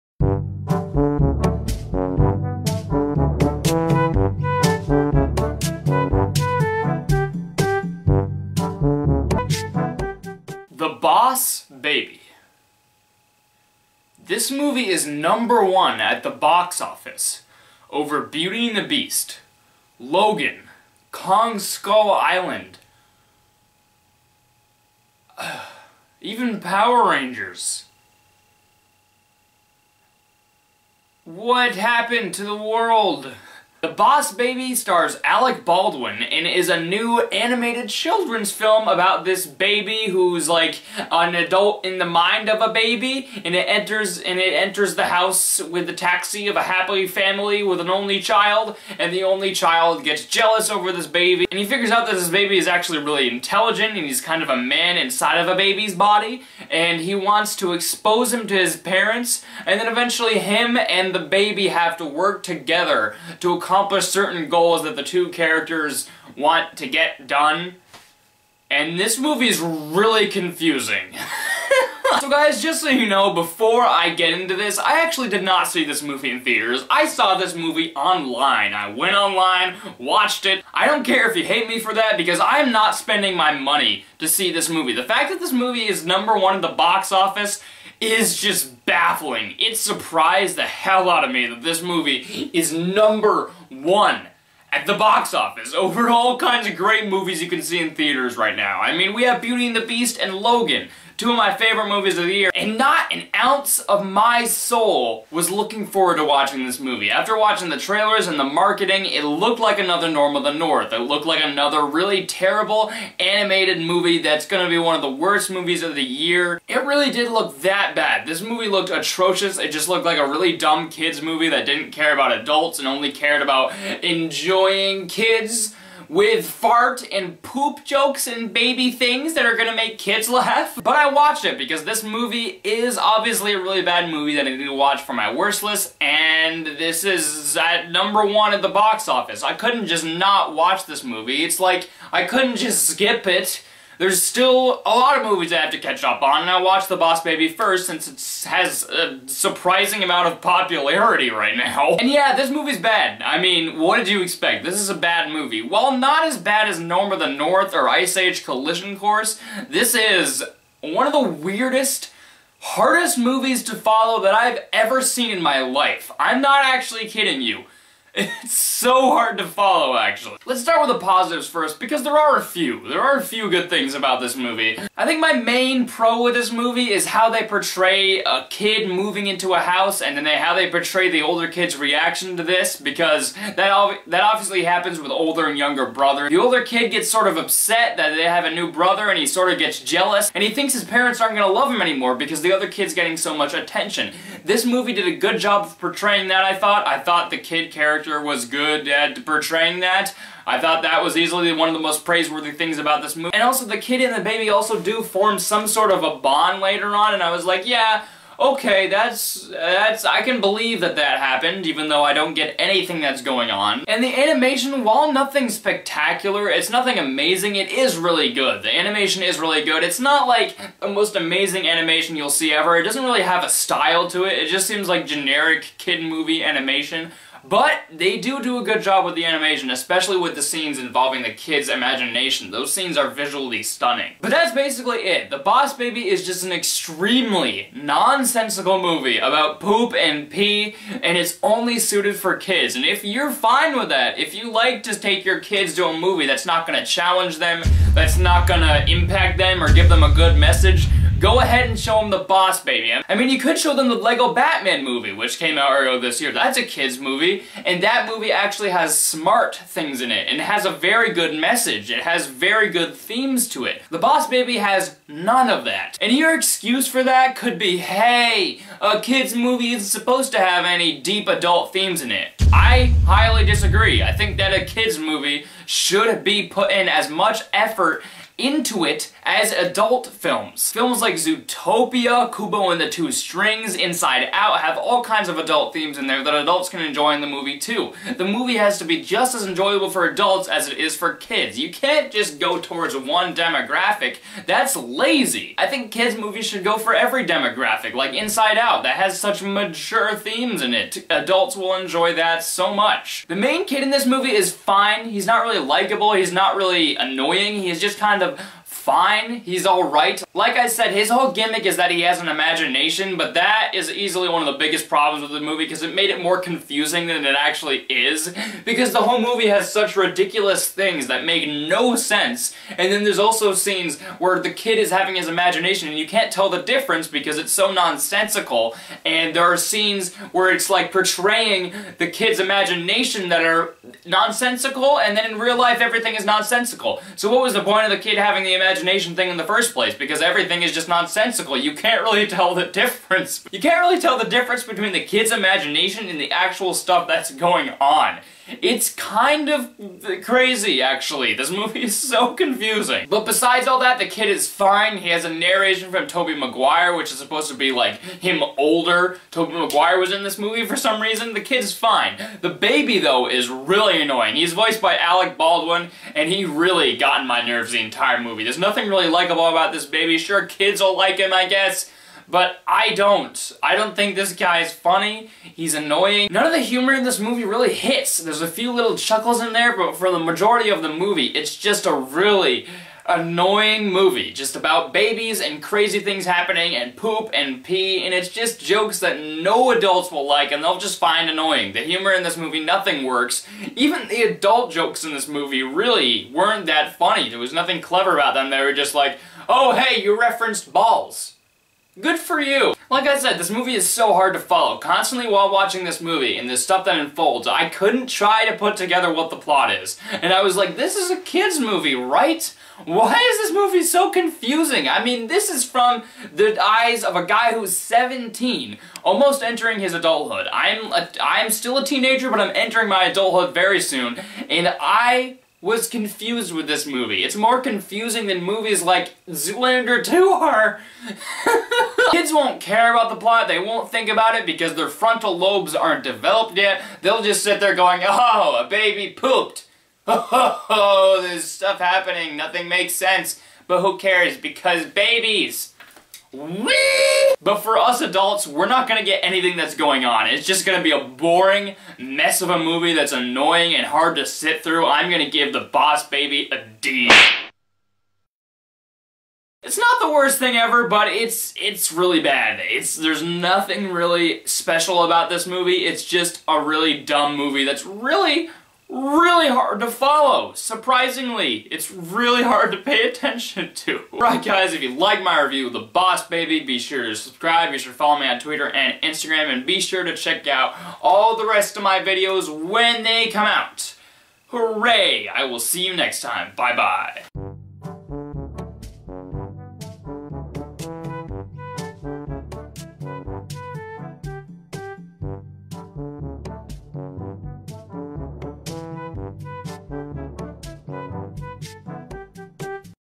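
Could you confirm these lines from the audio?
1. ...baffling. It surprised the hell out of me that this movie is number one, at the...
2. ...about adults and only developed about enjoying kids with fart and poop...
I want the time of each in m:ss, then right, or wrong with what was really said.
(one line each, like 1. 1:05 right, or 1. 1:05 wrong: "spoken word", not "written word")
1. 1:28 right
2. 2:02 wrong: "cared", not "developed".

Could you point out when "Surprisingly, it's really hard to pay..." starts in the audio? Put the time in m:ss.
7:50.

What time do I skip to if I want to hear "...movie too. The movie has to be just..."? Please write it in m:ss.
4:47.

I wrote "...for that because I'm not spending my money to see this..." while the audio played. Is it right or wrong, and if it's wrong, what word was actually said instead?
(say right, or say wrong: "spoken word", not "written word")
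right.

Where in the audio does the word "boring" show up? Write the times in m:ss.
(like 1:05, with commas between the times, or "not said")
7:31.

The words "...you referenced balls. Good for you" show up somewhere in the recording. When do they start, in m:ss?
6:40.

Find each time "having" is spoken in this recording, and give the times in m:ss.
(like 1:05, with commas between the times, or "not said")
5:24, 5:38.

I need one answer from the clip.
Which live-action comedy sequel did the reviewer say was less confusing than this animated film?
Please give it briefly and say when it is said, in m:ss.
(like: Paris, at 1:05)
Zoolander 2, at 7:09.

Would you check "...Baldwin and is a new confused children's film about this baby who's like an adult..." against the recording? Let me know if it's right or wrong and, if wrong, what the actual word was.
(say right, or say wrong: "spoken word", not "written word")
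wrong: "animated", not "confused".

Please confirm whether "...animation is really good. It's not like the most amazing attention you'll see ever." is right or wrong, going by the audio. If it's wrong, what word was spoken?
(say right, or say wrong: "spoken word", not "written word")
wrong: "animation", not "attention".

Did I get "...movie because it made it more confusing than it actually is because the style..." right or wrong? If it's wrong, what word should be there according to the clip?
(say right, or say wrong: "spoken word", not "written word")
wrong: "whole", not "style".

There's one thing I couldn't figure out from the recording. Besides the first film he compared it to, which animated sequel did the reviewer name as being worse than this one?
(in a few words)
Ice Age Collision Course.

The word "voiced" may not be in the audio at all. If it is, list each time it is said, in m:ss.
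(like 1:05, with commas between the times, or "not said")
6:04.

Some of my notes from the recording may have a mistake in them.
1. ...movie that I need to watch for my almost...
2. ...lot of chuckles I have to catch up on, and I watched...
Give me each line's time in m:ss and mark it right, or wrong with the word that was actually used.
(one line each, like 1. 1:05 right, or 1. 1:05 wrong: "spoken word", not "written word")
1. 2:14 wrong: "worst", not "almost"
2. 2:24 wrong: "movies", not "chuckles".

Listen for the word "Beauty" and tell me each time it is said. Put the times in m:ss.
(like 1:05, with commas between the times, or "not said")
0:18, 1:39.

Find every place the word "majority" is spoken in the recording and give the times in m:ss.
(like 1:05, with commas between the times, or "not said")
6:20.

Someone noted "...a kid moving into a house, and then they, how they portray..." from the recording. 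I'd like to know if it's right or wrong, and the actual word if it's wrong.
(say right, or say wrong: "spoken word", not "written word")
right.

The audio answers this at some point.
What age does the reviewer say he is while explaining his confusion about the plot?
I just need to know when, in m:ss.
6:57.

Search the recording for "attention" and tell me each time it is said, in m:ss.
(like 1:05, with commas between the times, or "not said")
3:13, 7:53.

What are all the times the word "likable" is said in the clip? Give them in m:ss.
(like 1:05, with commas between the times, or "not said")
5:05, 6:09.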